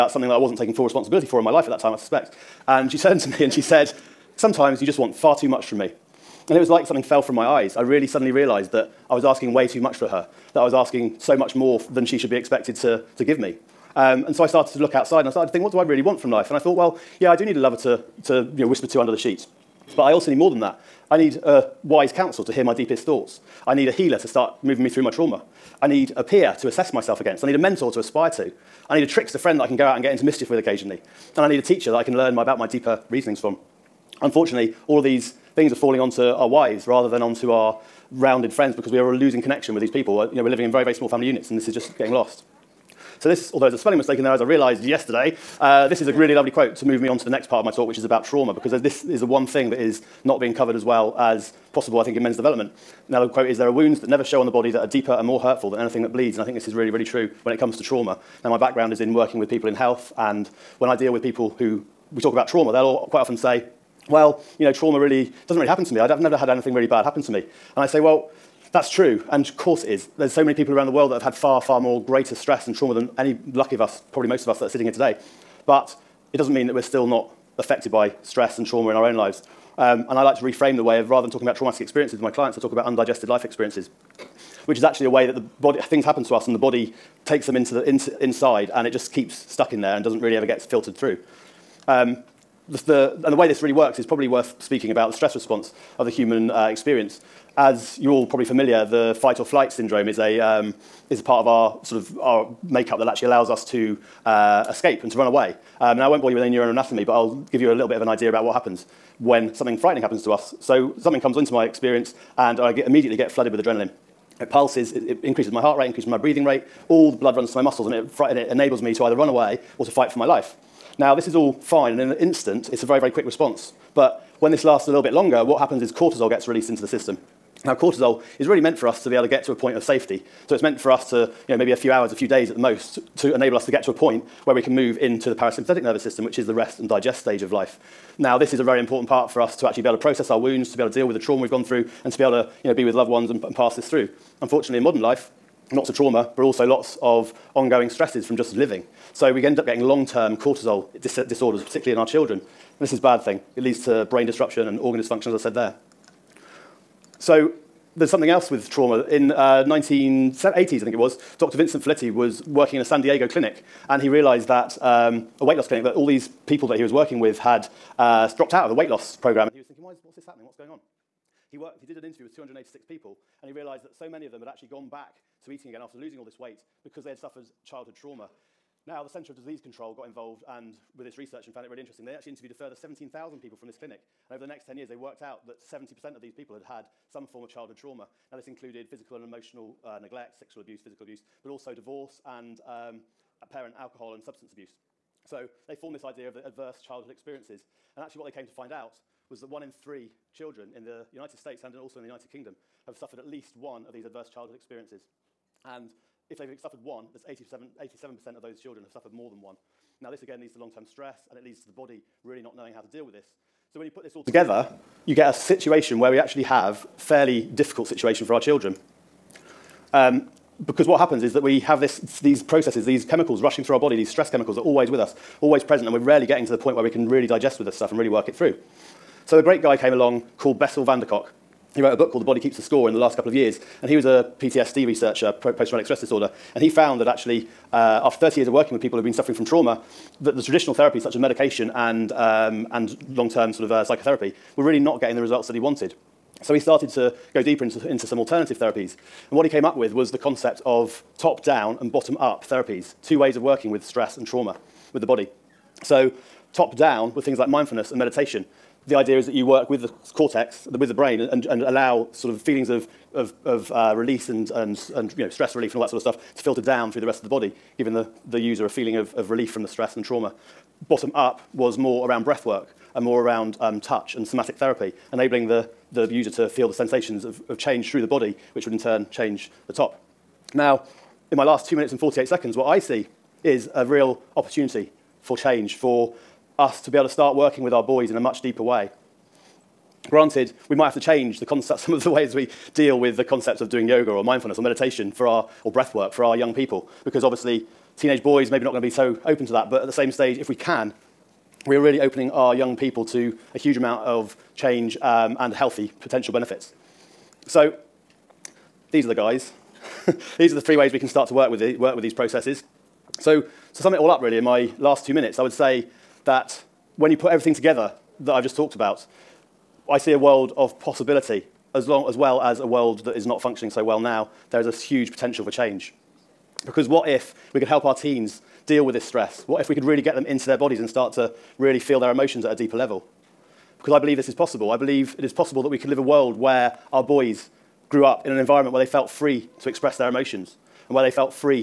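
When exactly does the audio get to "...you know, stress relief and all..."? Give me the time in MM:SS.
04:25.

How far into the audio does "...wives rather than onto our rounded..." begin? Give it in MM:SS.
00:36.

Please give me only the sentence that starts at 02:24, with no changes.
Unfortunately, in modern life, lots of trauma, but also lots of ongoing stresses from just living.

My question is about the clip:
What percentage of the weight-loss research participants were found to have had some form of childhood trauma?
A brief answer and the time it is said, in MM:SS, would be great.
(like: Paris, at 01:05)
70%, at 03:05.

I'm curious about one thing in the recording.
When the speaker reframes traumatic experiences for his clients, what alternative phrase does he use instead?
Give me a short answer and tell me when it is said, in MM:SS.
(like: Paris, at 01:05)
undigested life experiences, at 01:22.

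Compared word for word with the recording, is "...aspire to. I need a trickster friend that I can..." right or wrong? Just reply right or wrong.
right.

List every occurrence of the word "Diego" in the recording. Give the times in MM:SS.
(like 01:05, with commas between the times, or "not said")
02:43.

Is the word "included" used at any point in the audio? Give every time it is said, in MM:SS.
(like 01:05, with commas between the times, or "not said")
03:08.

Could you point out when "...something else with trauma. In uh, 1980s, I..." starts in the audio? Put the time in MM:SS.
02:38.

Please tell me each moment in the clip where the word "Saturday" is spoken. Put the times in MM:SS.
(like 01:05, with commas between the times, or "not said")
not said.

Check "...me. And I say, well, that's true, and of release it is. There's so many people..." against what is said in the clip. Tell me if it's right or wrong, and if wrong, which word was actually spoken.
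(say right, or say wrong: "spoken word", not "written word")
wrong: "course", not "release".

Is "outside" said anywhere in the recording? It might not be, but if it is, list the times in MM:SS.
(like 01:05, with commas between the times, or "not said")
00:14.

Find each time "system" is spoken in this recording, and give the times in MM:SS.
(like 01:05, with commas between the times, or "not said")
02:06, 02:16.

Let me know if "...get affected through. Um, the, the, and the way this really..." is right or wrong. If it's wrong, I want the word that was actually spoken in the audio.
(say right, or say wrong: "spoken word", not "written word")
wrong: "filtered", not "affected".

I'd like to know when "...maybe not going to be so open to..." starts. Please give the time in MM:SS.
04:58.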